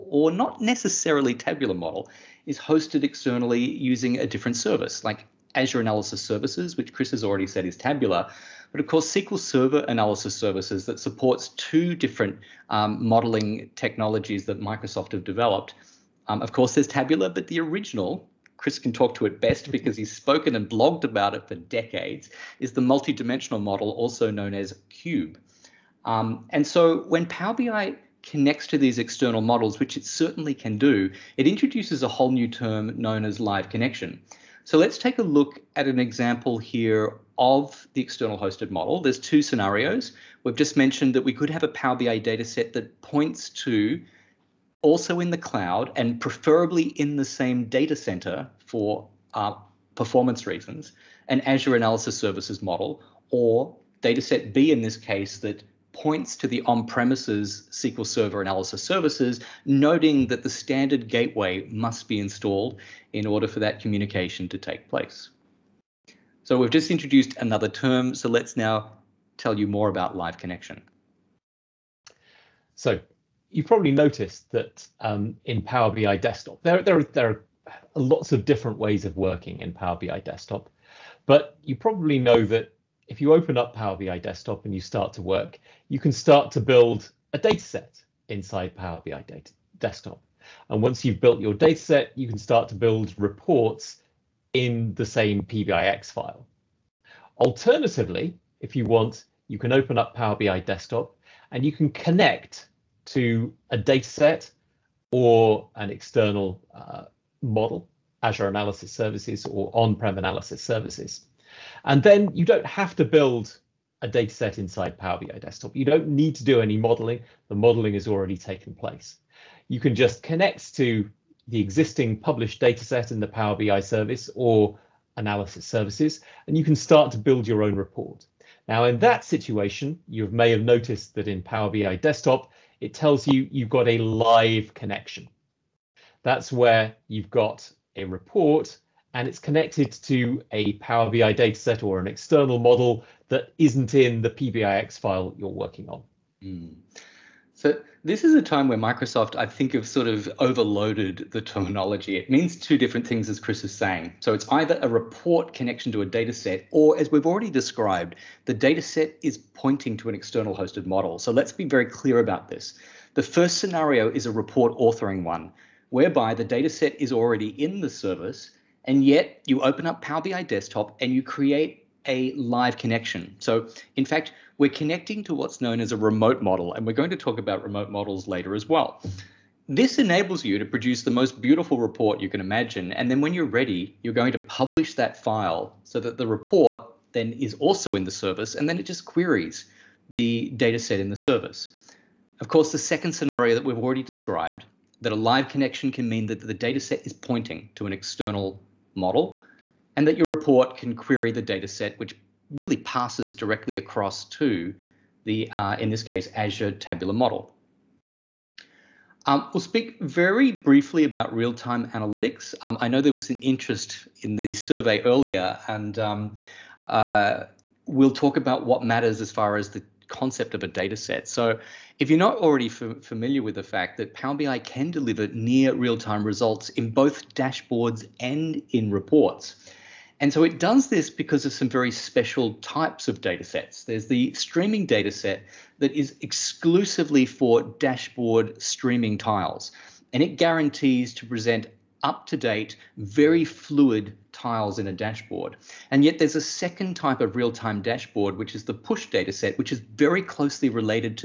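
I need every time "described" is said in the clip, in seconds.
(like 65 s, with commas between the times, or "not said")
157 s, 194 s.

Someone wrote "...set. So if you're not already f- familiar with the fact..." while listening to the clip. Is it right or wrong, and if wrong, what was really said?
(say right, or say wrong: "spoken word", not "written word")
right.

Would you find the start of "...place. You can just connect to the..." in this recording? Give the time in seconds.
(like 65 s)
118 s.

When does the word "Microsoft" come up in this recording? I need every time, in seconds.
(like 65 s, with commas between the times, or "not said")
14 s, 148 s.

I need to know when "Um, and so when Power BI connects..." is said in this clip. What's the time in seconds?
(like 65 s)
26 s.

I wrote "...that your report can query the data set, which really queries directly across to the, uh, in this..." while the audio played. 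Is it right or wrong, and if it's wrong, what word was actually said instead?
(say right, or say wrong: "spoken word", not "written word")
wrong: "passes", not "queries".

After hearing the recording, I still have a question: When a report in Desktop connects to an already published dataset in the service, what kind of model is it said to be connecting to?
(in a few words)
remote model.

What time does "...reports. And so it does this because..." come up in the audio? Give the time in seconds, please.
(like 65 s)
228 s.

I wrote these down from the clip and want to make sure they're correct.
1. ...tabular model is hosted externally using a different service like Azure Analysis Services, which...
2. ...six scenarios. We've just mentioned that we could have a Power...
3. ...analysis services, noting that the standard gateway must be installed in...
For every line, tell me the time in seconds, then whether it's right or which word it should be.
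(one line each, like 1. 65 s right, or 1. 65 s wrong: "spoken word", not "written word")
1. 1 s right
2. 39 s wrong: "two", not "six"
3. 58 s right.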